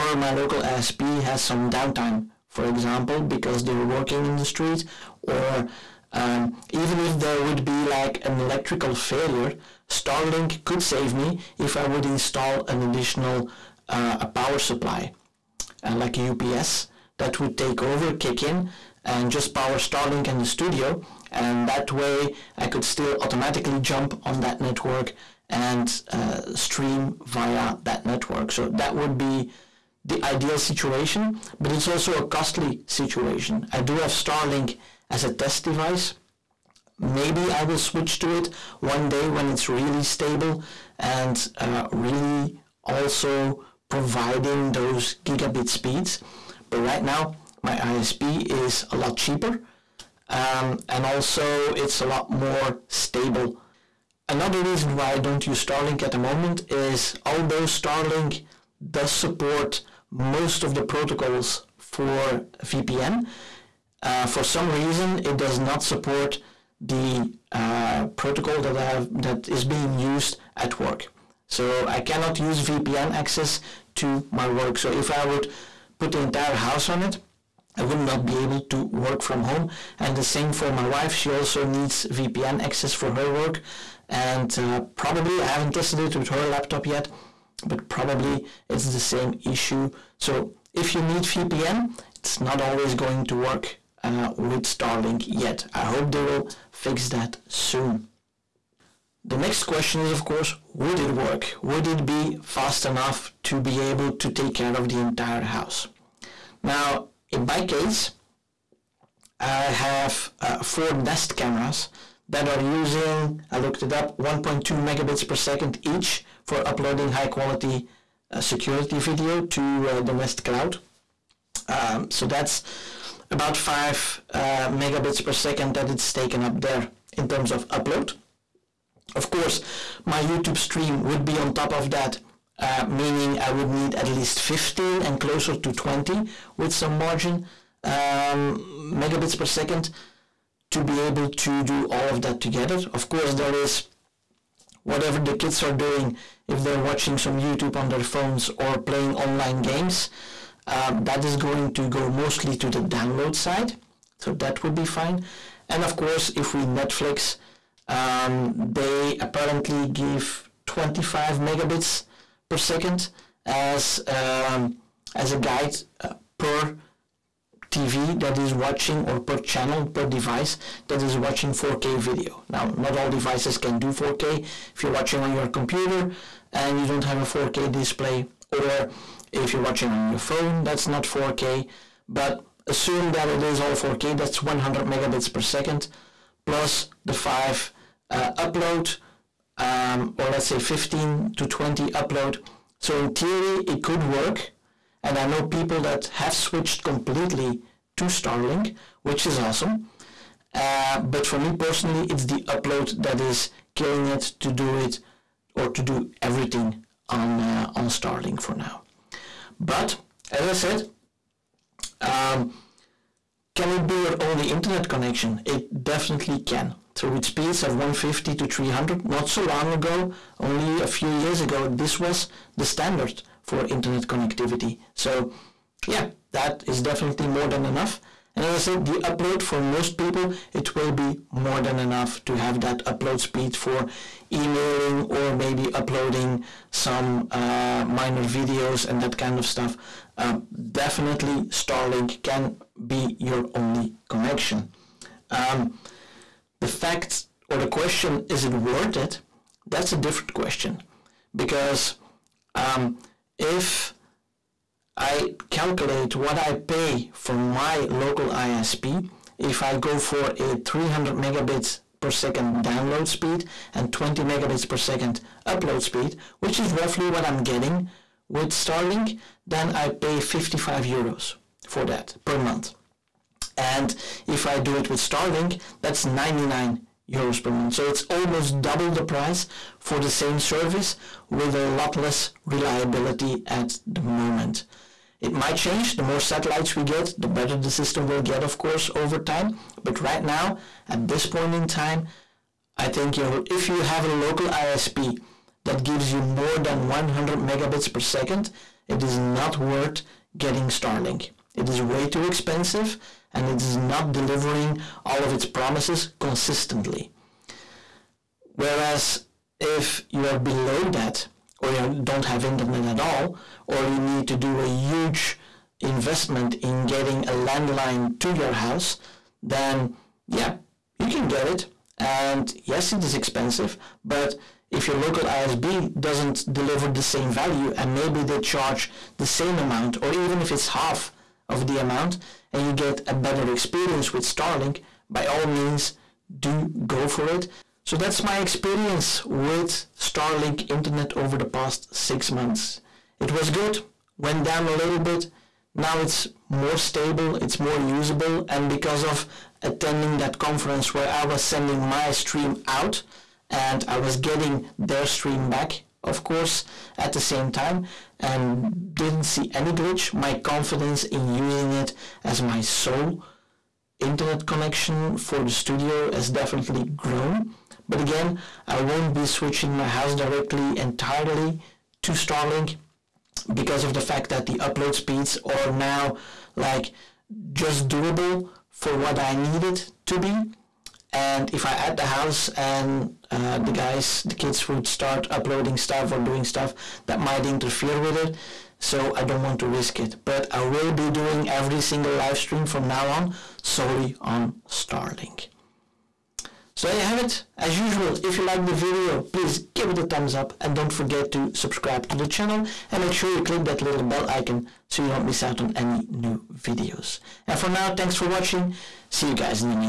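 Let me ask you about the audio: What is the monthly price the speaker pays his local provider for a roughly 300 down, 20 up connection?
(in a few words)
55 euros.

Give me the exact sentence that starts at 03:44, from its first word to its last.
So yeah, that is definitely more than enough.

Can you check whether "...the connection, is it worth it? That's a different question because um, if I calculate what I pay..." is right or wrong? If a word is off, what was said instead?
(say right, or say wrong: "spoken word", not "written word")
wrong: "question", not "connection".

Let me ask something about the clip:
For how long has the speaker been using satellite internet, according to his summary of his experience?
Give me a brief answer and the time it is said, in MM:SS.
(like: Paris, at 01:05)
6 months, at 05:41.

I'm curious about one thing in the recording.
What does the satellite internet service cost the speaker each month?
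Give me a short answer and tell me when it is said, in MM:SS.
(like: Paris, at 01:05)
99 euros, at 04:36.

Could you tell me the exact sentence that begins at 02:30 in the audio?
Um, that is going to go mostly to the download side.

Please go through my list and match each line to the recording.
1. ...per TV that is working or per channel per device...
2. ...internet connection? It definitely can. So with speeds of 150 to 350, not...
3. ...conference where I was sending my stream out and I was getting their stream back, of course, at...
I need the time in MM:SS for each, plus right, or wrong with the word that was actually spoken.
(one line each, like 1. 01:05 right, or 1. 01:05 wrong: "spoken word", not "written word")
1. 02:46 wrong: "watching", not "working"
2. 03:34 wrong: "300", not "350"
3. 05:50 right.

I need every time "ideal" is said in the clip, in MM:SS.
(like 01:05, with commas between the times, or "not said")
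00:30.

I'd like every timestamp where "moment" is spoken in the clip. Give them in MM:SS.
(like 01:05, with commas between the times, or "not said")
00:56, 04:44.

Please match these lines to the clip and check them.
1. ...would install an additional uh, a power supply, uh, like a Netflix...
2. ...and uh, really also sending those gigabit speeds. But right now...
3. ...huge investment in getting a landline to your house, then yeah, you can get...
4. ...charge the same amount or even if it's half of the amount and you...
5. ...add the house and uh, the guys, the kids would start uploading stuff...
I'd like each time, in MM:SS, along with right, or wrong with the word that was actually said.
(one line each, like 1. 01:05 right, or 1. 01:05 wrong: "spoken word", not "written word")
1. 00:11 wrong: "UPS", not "Netflix"
2. 00:40 wrong: "providing", not "sending"
3. 05:14 right
4. 05:28 right
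5. 06:21 right.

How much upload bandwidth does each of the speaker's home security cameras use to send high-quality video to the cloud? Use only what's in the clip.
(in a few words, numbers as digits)
1.2 Mbps.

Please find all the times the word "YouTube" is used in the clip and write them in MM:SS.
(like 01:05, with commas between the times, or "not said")
02:10, 02:27.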